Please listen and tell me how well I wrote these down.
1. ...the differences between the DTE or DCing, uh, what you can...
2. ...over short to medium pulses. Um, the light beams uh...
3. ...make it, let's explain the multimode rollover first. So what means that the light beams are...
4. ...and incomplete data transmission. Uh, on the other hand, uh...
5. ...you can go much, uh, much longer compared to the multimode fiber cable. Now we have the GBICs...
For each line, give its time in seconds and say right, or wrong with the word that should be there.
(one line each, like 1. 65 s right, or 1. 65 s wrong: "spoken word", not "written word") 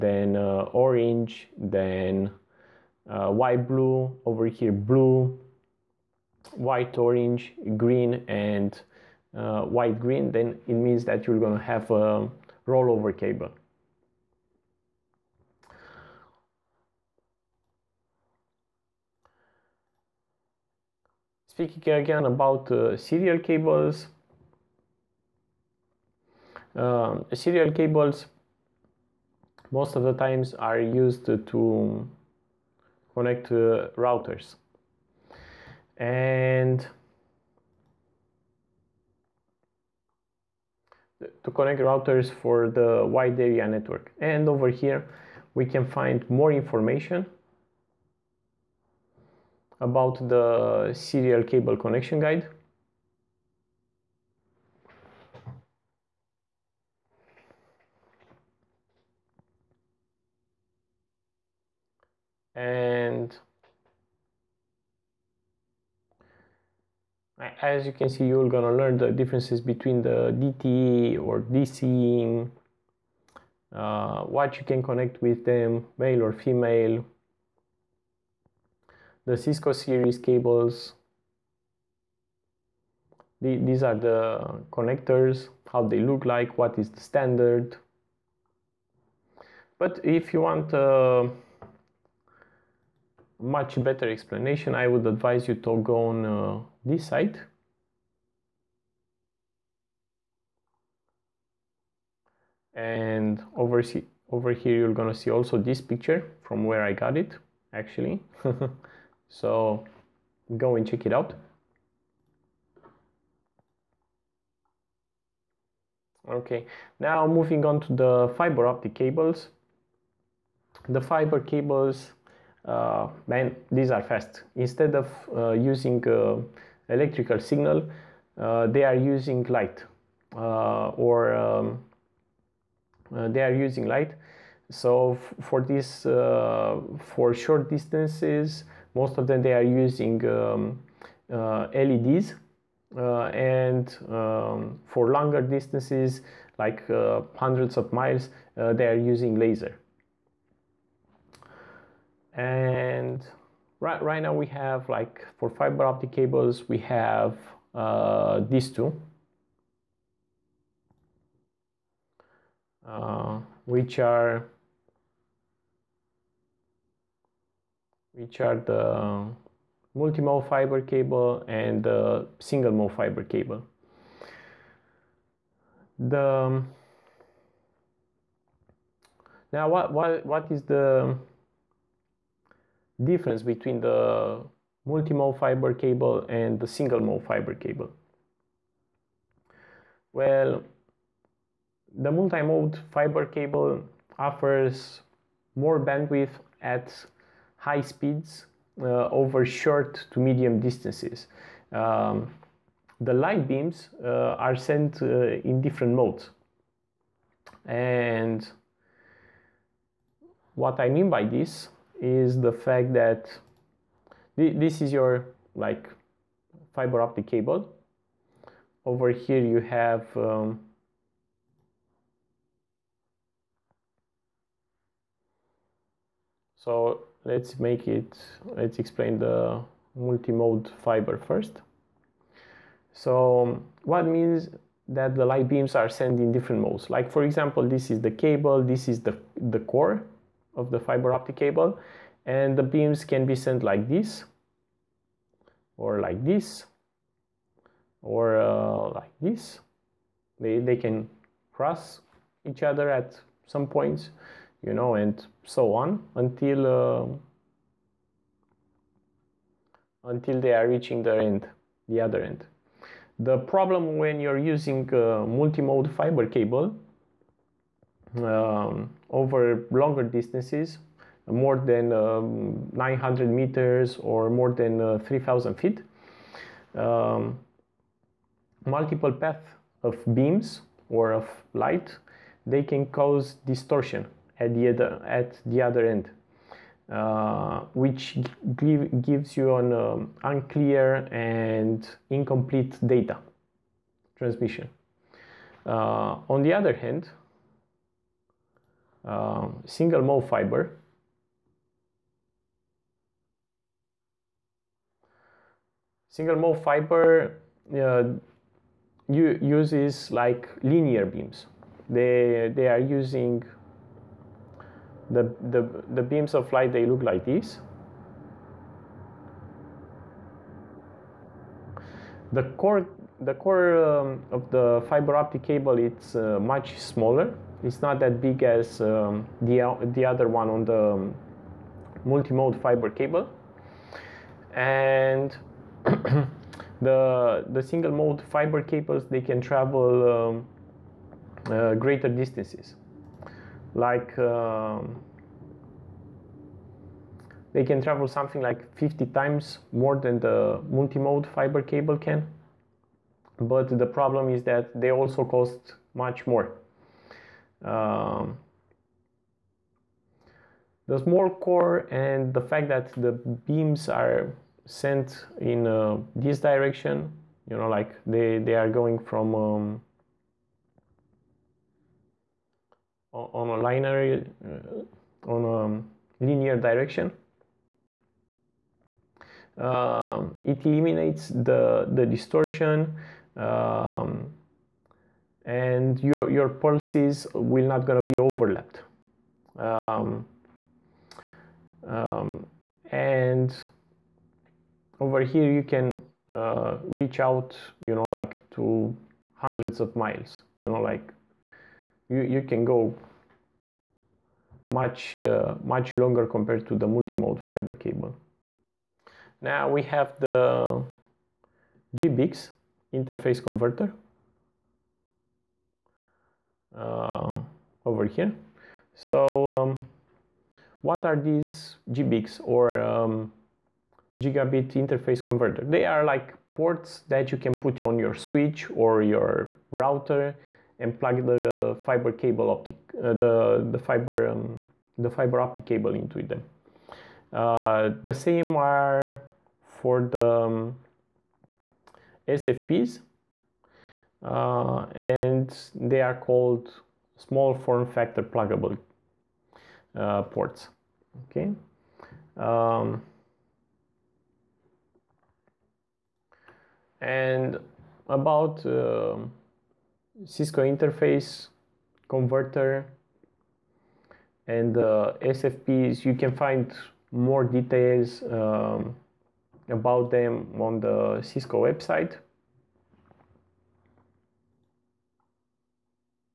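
1. 68 s right
2. 199 s wrong: "distances", not "pulses"
3. 227 s wrong: "fiber", not "rollover"
4. 291 s right
5. 402 s right.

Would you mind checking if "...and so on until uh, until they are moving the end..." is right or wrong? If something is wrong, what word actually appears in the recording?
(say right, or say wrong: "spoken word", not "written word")
wrong: "reaching", not "moving".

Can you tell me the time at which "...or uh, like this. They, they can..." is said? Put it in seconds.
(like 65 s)
248 s.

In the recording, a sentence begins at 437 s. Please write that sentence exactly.
Uh, the same are for the um, SFPs uh, and they are called small form factor pluggable uh, ports.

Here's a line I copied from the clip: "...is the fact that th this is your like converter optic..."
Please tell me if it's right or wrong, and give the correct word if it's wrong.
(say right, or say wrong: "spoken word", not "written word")
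wrong: "fiber", not "converter".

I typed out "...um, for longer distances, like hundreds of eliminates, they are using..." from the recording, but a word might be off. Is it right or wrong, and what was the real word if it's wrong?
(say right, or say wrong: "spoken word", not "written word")
wrong: "miles", not "eliminates".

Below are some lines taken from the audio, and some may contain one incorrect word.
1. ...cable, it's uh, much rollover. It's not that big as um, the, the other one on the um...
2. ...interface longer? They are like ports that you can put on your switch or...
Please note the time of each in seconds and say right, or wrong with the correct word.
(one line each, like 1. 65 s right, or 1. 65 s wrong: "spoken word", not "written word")
1. 325 s wrong: "smaller", not "rollover"
2. 424 s wrong: "converter", not "longer".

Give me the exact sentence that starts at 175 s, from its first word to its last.
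The now what what what is the difference between the multi-mode fiber cable and the single mode fiber cable?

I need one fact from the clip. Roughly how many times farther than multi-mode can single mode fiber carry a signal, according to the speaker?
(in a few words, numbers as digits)
50 times.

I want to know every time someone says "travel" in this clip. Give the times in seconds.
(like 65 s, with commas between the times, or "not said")
339 s, 347 s.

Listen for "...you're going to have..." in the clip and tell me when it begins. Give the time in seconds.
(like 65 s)
11 s.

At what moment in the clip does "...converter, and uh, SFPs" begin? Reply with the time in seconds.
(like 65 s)
462 s.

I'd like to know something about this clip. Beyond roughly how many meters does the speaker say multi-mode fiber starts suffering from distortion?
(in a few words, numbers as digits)
900 meters.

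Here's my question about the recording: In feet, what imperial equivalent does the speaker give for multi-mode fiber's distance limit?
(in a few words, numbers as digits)
3,000 feet.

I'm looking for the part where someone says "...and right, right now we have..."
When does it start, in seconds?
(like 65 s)
152 s.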